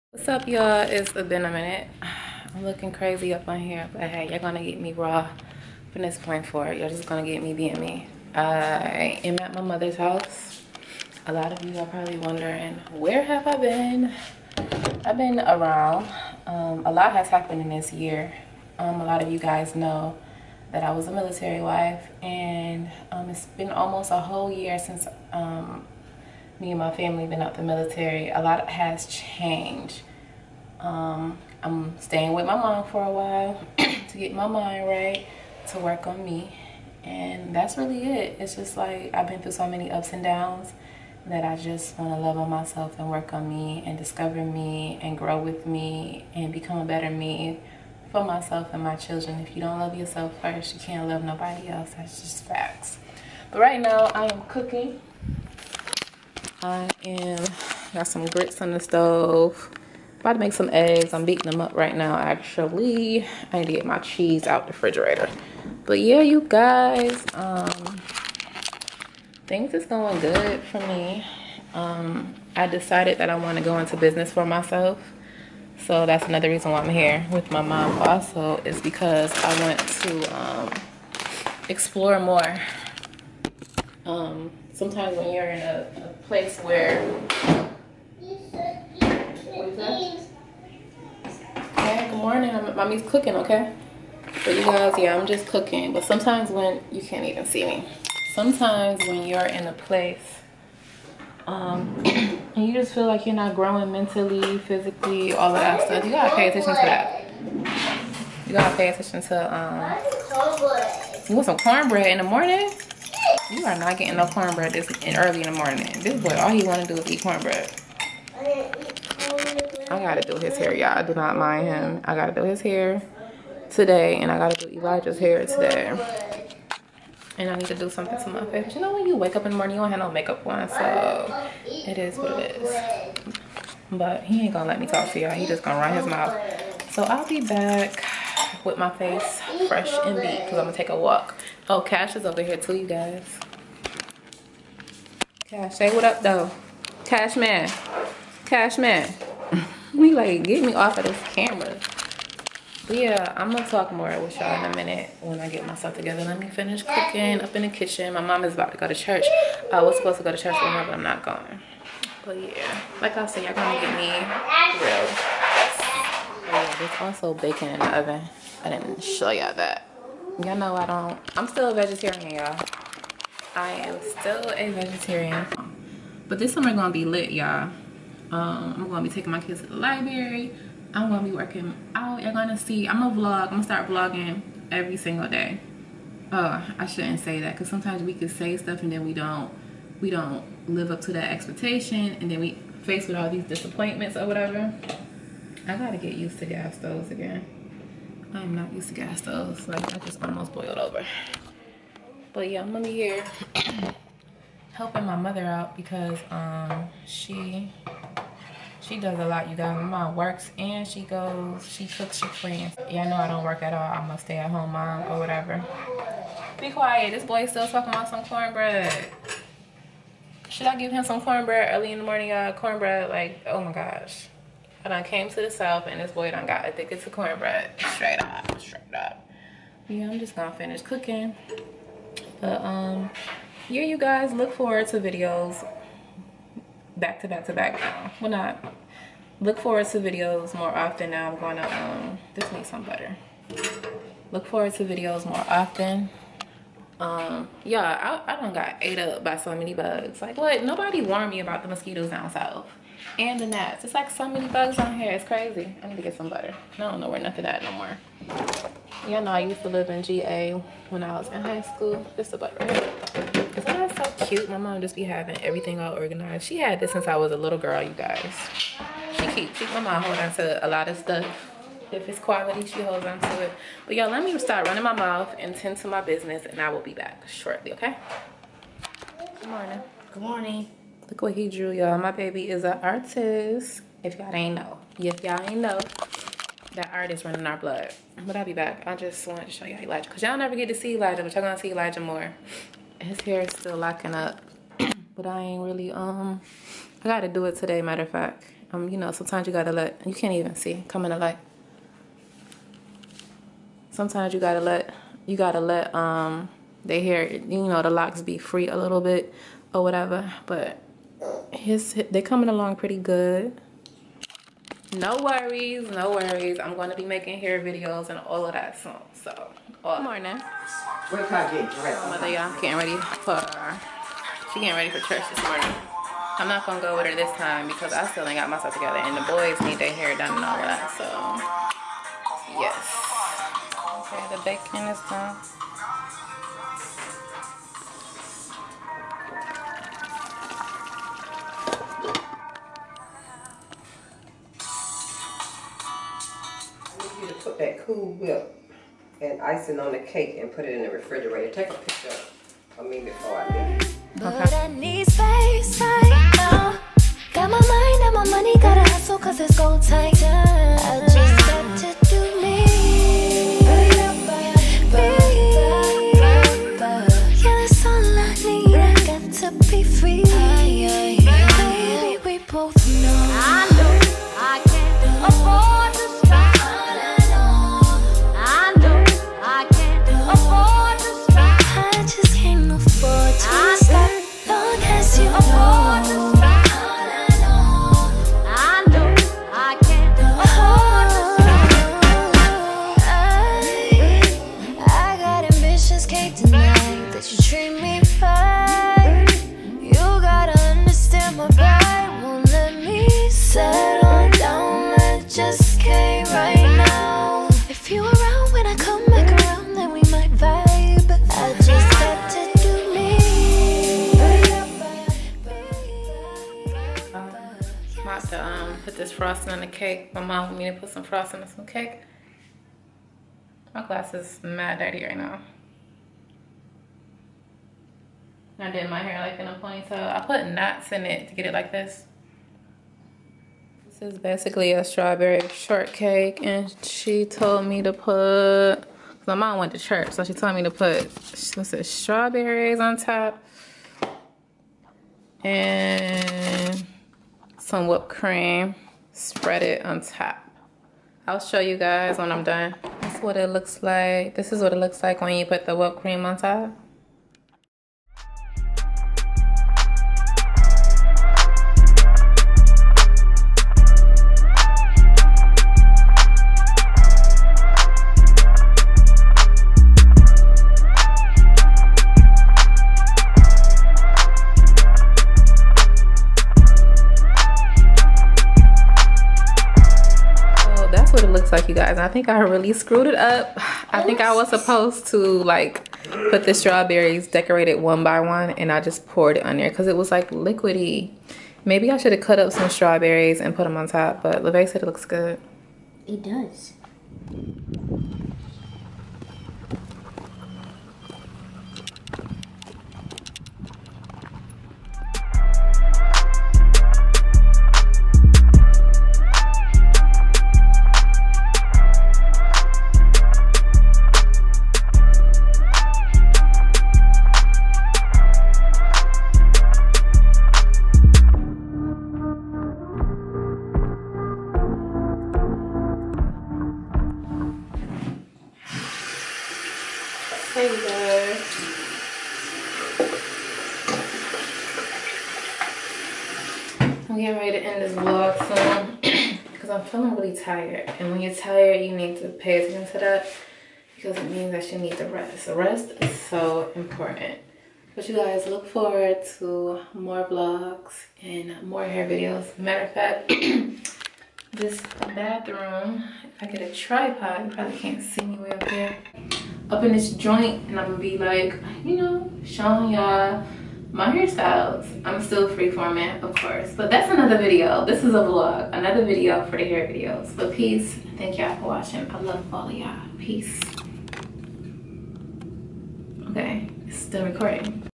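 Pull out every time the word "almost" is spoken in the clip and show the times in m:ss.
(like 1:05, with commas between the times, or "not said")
0:23, 3:20.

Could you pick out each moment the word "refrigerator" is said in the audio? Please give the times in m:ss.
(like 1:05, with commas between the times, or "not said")
1:04, 5:50.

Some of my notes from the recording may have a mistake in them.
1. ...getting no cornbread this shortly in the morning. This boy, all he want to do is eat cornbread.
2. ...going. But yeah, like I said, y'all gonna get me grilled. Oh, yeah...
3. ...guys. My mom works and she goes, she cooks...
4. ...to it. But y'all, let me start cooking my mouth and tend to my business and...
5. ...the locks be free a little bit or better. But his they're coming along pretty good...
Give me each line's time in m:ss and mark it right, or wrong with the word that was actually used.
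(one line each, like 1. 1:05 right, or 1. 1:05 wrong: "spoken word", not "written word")
1. 1:53 wrong: "early", not "shortly"
2. 2:41 right
3. 3:29 right
4. 4:33 wrong: "running", not "cooking"
5. 5:07 wrong: "whatever", not "better".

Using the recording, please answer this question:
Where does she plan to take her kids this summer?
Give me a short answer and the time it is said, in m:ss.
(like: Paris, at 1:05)
The library, at 2:59.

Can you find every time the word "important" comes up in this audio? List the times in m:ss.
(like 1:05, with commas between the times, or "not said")
9:06.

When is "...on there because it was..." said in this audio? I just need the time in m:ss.
8:09.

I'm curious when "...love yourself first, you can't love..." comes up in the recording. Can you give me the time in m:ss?
0:49.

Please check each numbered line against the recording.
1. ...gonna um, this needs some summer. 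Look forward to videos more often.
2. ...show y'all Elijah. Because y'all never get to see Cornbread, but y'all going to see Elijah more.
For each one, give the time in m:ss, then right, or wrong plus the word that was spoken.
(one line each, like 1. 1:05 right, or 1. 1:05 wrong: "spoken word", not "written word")
1. 4:01 wrong: "butter", not "summer"
2. 4:49 wrong: "Elijah", not "Cornbread".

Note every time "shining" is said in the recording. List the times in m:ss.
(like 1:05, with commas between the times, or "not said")
not said.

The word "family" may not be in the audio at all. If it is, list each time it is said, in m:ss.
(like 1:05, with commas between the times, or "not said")
0:26.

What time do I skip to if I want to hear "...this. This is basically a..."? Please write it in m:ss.
7:11.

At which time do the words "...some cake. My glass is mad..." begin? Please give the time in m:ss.
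7:01.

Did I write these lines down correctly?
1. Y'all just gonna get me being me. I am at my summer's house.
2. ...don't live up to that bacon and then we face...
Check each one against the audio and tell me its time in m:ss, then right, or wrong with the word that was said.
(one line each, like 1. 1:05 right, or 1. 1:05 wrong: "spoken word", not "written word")
1. 0:06 wrong: "mother", not "summer"
2. 3:10 wrong: "expectation", not "bacon".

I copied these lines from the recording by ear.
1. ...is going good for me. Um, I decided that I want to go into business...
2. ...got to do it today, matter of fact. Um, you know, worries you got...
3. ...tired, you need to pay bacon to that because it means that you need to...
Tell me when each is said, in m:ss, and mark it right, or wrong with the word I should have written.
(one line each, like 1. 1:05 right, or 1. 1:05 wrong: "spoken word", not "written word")
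1. 1:09 right
2. 4:57 wrong: "sometimes", not "worries"
3. 9:01 wrong: "attention", not "bacon".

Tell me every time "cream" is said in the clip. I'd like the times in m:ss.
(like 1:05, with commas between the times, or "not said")
7:28, 7:36.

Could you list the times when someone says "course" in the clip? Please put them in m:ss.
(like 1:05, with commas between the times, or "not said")
9:26.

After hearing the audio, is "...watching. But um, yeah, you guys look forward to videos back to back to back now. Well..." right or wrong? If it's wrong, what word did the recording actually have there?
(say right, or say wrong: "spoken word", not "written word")
wrong: "cooking", not "watching".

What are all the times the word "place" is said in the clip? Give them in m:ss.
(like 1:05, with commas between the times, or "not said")
1:26, 1:39.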